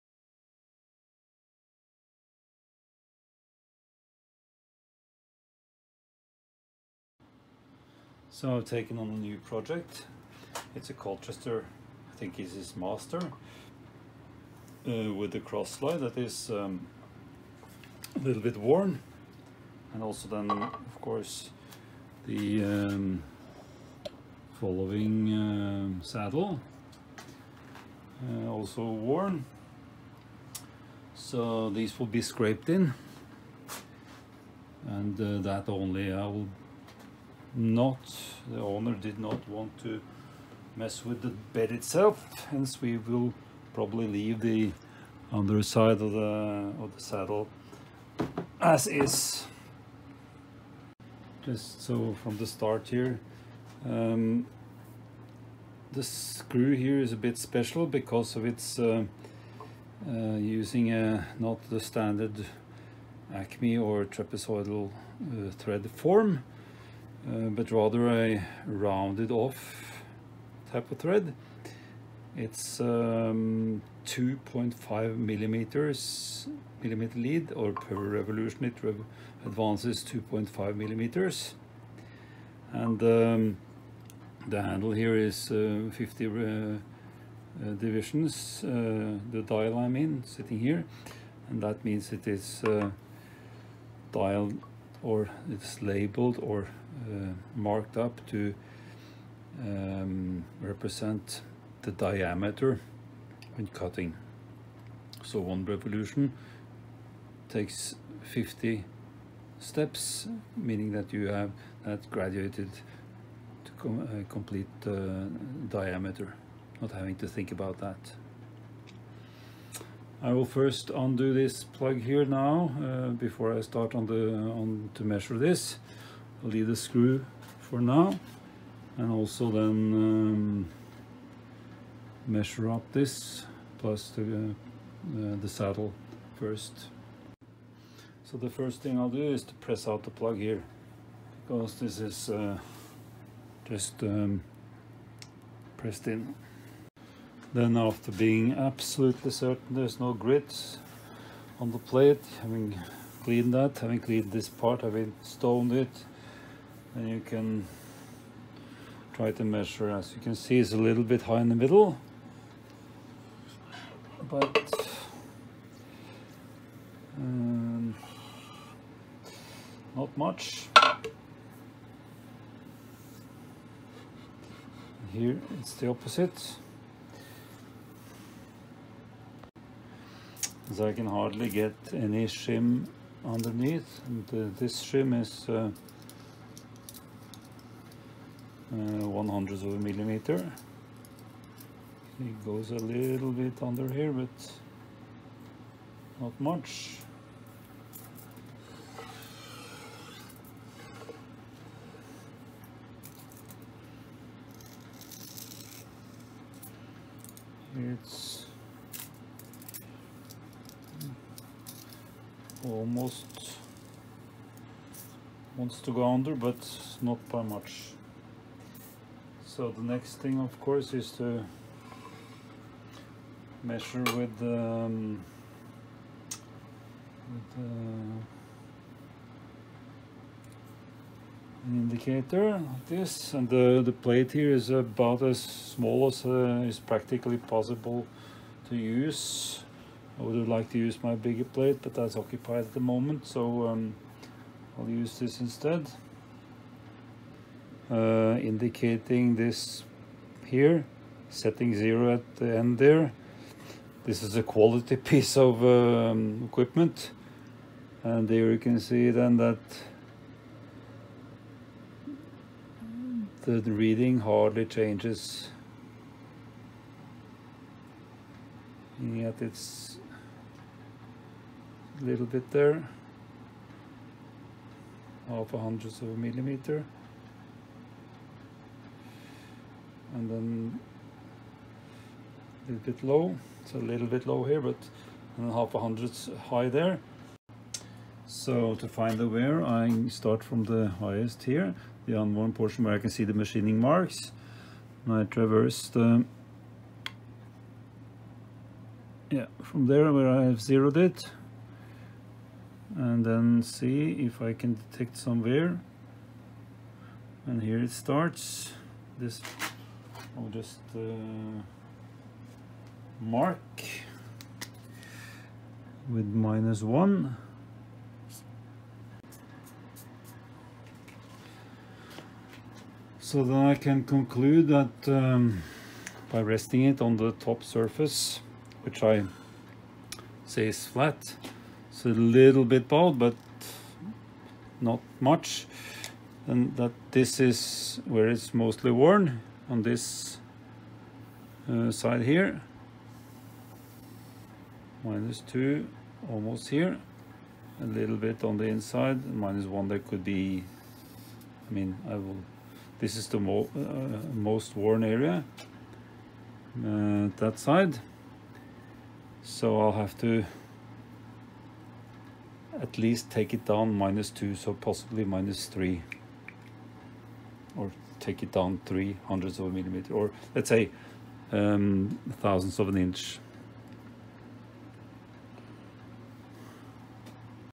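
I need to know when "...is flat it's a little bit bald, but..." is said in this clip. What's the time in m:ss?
5:30.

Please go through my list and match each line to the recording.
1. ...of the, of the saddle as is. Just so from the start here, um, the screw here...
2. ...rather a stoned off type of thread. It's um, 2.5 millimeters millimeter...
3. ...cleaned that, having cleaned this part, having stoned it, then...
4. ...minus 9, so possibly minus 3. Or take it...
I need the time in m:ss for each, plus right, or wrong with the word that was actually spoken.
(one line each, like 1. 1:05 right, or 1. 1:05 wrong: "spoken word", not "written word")
1. 0:46 right
2. 1:07 wrong: "rounded", not "stoned"
3. 2:33 right
4. 6:03 wrong: "2", not "9".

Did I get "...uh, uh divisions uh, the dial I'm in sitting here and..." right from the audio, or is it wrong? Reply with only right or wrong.
right.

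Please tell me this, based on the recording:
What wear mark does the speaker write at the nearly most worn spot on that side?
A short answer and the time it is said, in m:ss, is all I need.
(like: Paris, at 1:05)
minus 2, at 5:45.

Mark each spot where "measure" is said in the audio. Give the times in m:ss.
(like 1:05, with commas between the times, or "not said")
2:05, 2:12, 2:39, 3:43.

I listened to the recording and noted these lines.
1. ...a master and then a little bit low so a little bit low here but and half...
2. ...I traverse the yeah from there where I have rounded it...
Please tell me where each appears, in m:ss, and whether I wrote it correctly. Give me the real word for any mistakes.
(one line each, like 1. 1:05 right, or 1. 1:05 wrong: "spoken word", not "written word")
1. 4:36 wrong: "millimeter", not "master"
2. 4:55 wrong: "zeroed", not "rounded".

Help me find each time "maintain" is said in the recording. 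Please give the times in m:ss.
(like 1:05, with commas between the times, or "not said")
not said.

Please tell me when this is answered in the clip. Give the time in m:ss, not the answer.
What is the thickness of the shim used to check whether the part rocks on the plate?
3:09.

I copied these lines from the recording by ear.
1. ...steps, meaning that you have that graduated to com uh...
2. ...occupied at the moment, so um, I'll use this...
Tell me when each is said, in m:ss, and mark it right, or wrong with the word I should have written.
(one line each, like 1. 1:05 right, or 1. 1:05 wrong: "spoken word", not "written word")
1. 1:49 right
2. 4:02 right.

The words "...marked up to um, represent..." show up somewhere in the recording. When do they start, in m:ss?
1:37.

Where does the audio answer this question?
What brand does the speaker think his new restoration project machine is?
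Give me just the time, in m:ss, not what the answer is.
0:10.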